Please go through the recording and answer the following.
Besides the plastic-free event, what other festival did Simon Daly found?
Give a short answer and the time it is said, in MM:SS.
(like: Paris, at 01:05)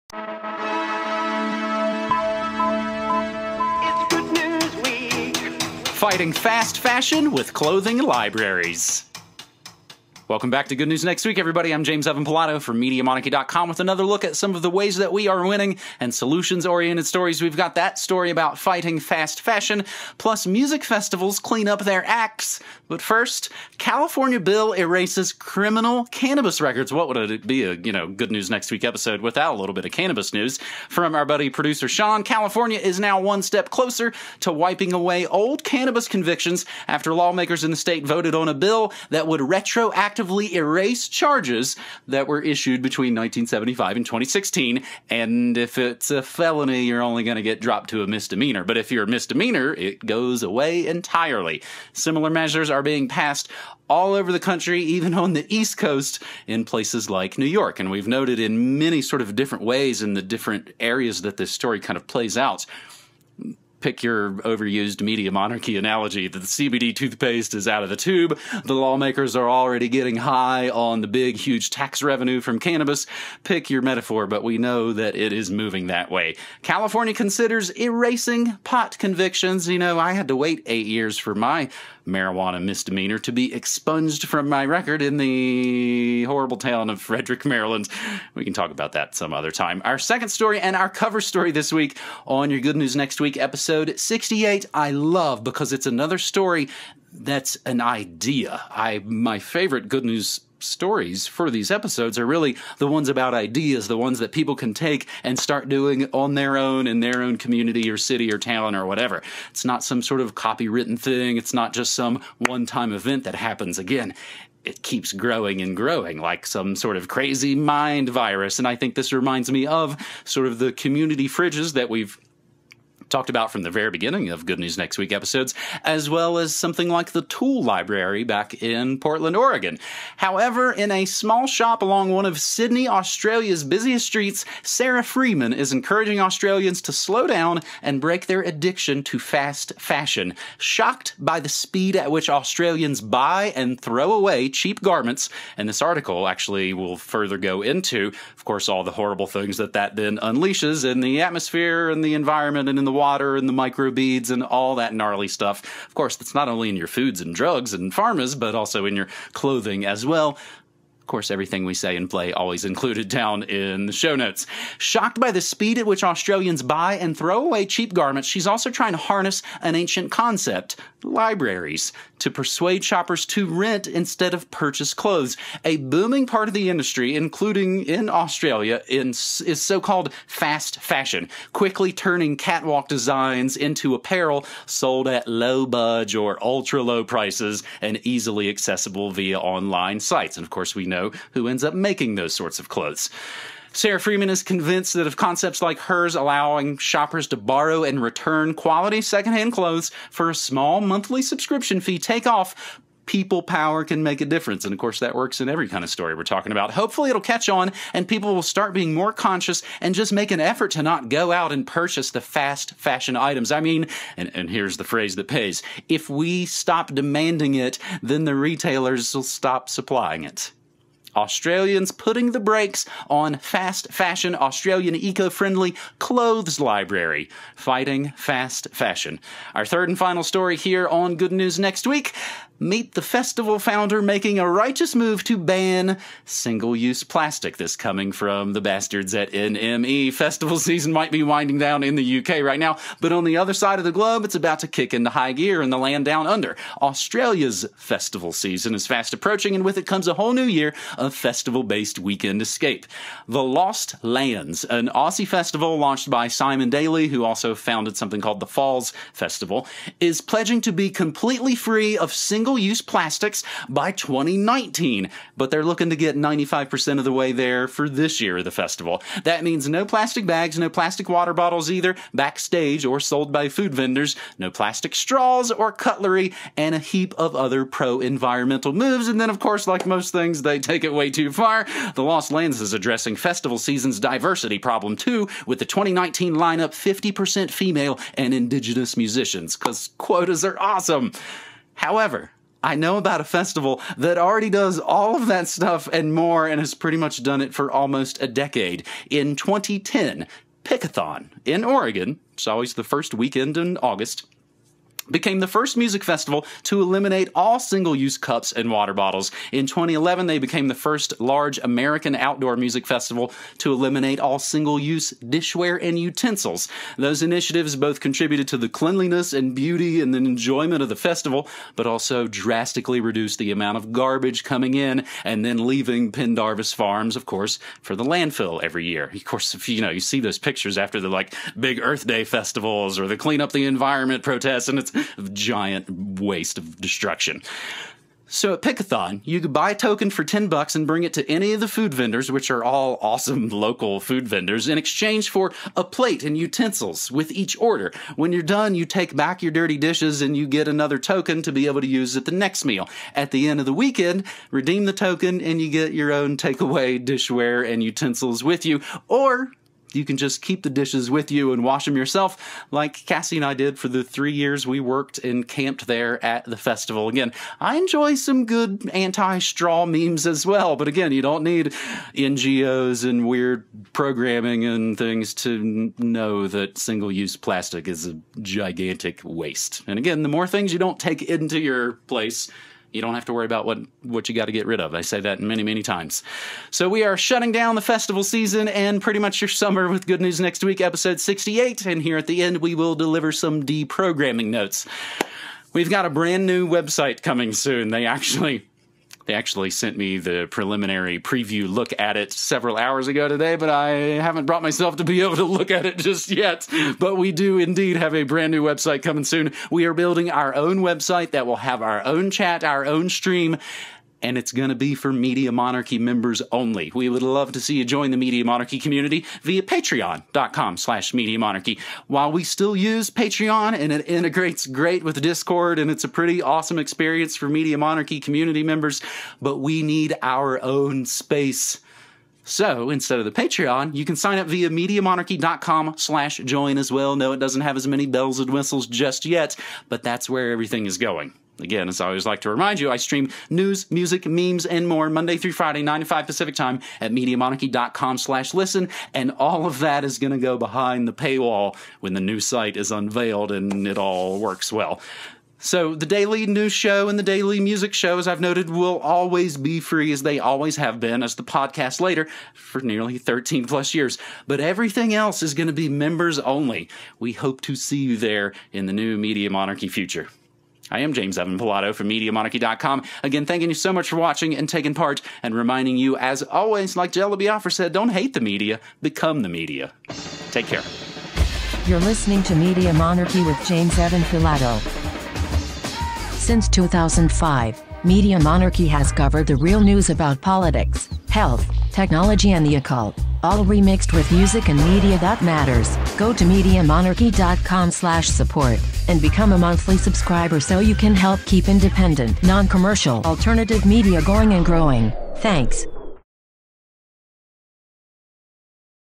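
Falls Festival, at 04:18.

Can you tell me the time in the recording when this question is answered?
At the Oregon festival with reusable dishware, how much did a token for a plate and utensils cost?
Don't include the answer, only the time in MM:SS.
05:40.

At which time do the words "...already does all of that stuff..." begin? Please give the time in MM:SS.
04:54.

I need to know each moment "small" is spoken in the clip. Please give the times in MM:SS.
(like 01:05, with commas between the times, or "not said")
02:11, 03:20.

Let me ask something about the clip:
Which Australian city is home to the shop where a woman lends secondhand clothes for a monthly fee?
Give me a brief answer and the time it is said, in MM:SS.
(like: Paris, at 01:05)
Sydney, at 02:12.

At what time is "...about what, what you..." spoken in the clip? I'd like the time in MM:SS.
06:23.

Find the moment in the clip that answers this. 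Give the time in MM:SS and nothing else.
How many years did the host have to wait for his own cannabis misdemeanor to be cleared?
01:20.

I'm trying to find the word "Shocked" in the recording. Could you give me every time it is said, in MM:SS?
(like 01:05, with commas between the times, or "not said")
02:20, 02:44.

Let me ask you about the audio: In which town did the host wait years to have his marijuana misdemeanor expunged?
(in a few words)
Frederick, Maryland.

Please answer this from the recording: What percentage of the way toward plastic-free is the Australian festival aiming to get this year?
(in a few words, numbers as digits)
95%.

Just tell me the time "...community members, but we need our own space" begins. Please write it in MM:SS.
07:08.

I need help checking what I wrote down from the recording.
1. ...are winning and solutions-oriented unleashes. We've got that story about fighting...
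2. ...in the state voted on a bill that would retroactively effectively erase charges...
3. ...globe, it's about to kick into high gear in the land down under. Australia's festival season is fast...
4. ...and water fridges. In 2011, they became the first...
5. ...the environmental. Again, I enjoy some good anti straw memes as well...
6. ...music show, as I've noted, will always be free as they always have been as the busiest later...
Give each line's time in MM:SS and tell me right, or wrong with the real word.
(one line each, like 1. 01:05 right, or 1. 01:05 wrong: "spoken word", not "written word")
1. 00:15 wrong: "stories", not "unleashes"
2. 00:37 right
3. 04:03 right
4. 05:08 wrong: "bottles", not "fridges"
5. 06:06 wrong: "festival", not "environmental"
6. 07:37 wrong: "podcast", not "busiest".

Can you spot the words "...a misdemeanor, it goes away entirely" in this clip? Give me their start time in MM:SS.
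00:49.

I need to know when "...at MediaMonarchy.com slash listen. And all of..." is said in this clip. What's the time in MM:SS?
07:26.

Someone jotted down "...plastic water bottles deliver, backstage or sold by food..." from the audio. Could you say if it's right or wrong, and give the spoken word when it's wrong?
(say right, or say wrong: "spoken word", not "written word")
wrong: "either", not "deliver".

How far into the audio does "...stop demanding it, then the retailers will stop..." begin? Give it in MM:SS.
03:36.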